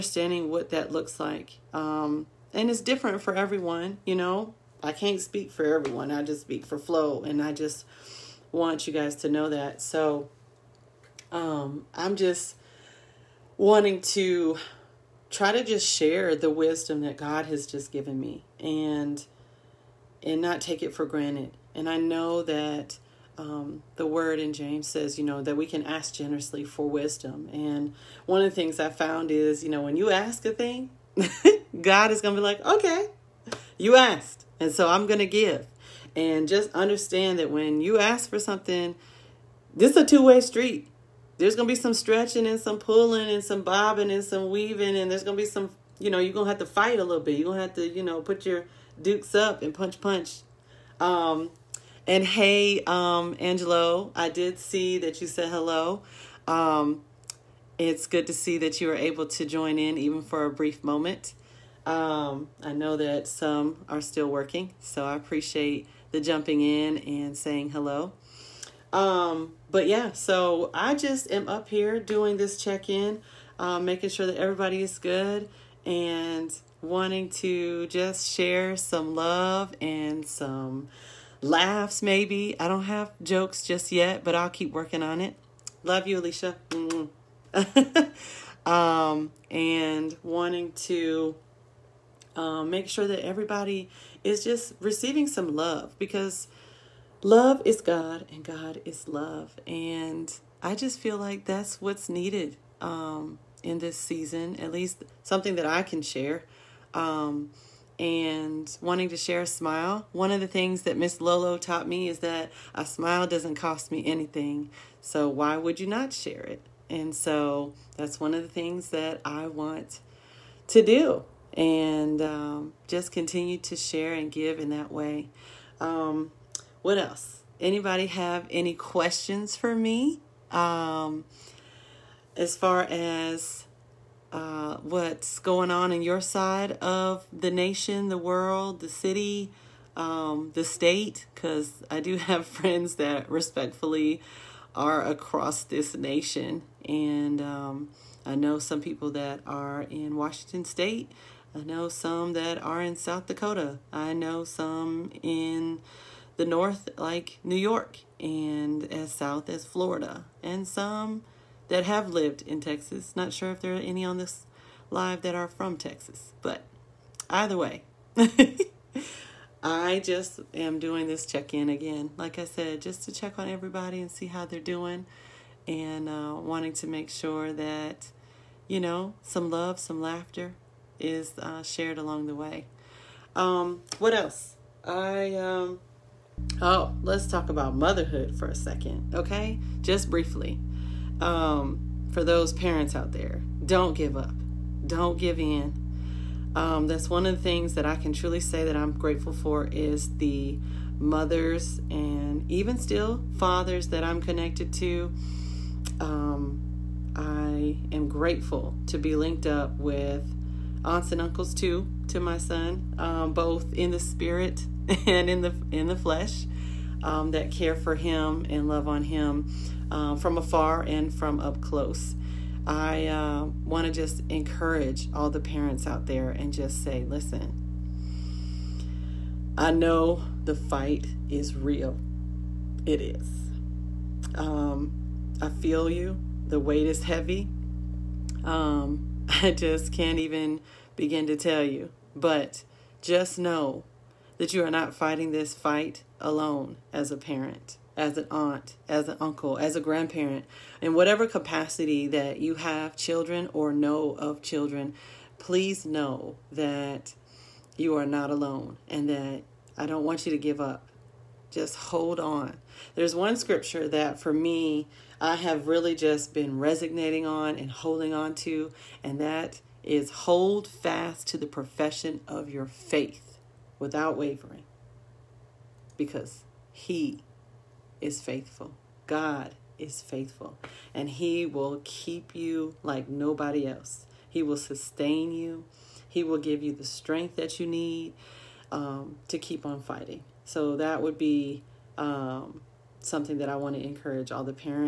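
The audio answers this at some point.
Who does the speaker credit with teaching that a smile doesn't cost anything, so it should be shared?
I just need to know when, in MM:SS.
01:50.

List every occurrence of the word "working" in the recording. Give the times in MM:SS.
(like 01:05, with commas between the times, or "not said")
01:04, 01:24.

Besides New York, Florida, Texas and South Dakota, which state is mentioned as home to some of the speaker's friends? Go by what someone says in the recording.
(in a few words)
Washington State.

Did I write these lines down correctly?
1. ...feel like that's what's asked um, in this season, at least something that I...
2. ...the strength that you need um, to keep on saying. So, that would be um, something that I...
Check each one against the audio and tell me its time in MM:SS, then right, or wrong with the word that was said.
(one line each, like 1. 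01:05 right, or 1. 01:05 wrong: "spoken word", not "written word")
1. 01:40 wrong: "needed", not "asked"
2. 04:46 wrong: "fighting", not "saying".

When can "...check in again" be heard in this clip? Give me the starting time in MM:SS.
02:51.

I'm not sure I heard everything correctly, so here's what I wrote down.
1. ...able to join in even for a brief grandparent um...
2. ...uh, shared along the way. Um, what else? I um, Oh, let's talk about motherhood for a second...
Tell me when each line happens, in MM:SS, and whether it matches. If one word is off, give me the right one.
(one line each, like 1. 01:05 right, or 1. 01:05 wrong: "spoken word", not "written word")
1. 00:58 wrong: "moment", not "grandparent"
2. 03:01 right.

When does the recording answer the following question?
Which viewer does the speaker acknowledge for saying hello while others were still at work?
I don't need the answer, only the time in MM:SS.
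00:53.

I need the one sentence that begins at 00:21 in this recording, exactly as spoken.
And I know that um, the word in James says, you know, that we can ask generously for wisdom.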